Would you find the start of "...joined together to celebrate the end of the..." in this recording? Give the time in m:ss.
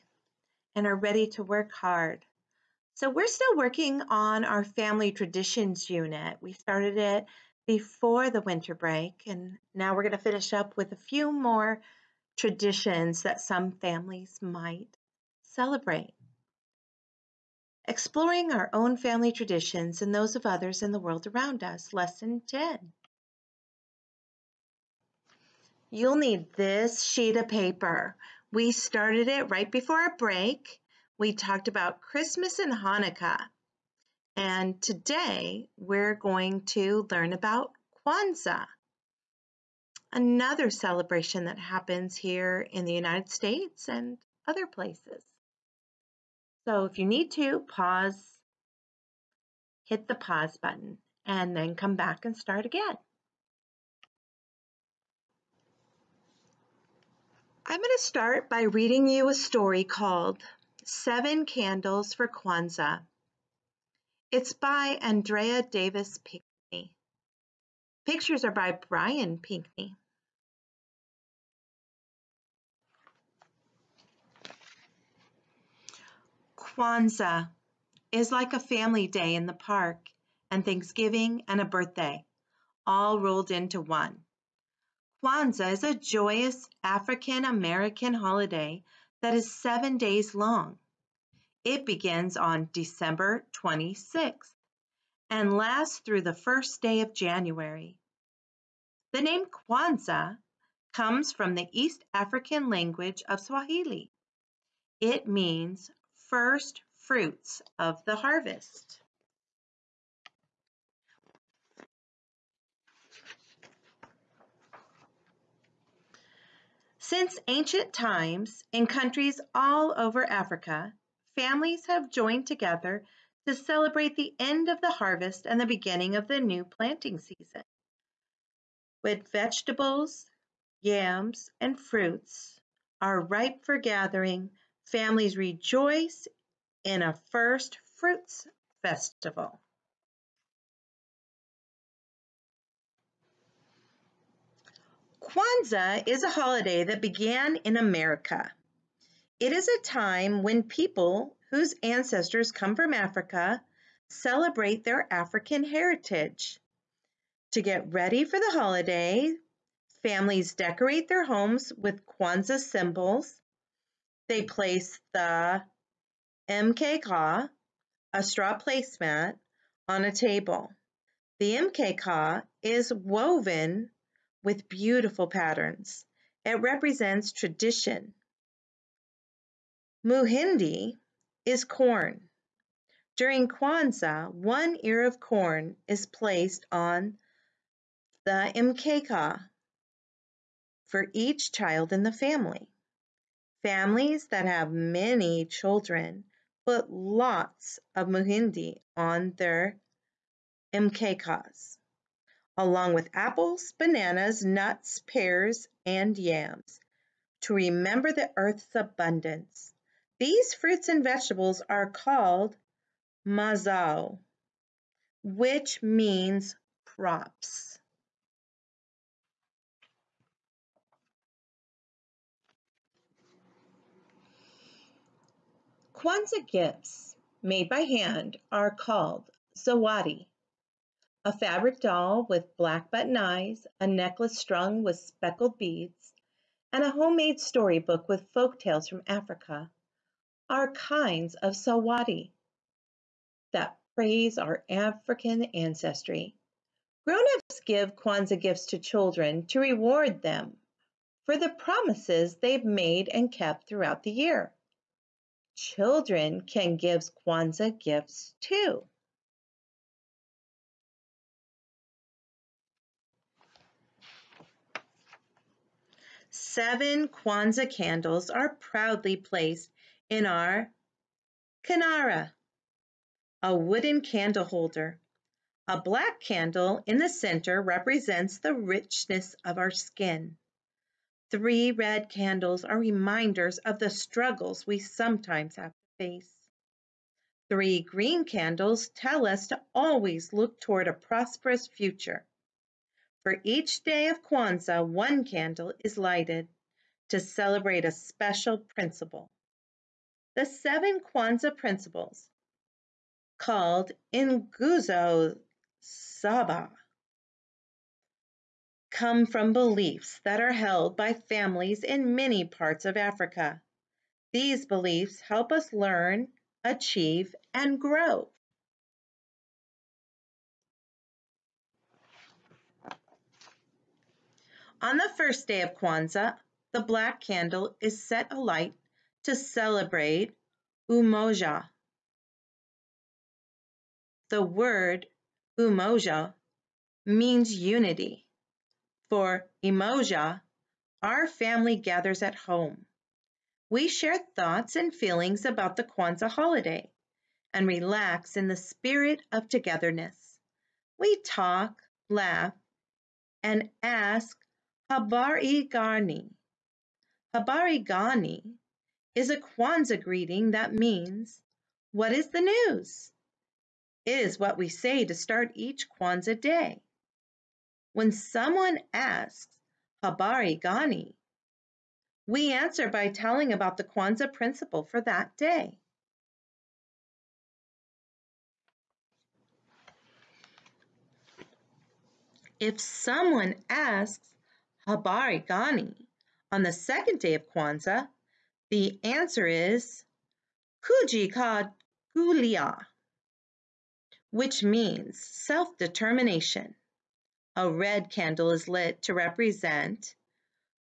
2:02.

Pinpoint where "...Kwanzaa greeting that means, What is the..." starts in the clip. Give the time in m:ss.
5:59.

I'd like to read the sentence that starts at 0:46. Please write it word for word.
So if you need to, pause, hit the pause button, and then come back and start again.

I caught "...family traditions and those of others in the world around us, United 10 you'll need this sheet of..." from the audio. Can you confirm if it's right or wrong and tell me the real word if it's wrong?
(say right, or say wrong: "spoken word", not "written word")
wrong: "Lesson", not "United".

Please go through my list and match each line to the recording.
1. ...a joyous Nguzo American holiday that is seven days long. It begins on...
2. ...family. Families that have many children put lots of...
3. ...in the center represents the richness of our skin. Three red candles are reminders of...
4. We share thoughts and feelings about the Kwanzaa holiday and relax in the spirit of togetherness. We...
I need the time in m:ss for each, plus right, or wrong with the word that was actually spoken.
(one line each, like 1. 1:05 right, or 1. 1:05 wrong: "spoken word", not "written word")
1. 1:25 wrong: "African", not "Nguzo"
2. 3:12 right
3. 4:36 right
4. 5:43 right.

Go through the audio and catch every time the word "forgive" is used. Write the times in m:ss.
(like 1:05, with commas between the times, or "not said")
not said.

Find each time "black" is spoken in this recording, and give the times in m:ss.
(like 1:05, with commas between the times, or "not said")
3:52, 4:35, 5:26.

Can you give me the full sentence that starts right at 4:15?
Children can give Kwanzaa gifts too.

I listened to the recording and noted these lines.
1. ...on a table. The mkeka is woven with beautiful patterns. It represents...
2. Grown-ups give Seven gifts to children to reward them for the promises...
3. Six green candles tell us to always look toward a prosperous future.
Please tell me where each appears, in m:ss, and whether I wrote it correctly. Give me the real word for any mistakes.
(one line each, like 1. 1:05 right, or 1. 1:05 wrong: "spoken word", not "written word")
1. 2:49 right
2. 4:07 wrong: "Kwanzaa", not "Seven"
3. 4:47 wrong: "Three", not "Six".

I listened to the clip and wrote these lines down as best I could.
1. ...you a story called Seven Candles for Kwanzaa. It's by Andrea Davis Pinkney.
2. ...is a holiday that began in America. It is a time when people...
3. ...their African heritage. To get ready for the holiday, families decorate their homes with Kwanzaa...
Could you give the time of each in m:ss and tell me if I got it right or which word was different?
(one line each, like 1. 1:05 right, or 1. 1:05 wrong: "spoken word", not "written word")
1. 0:59 right
2. 2:26 right
3. 2:34 right.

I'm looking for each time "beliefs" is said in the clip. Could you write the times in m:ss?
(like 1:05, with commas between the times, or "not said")
5:09, 5:14.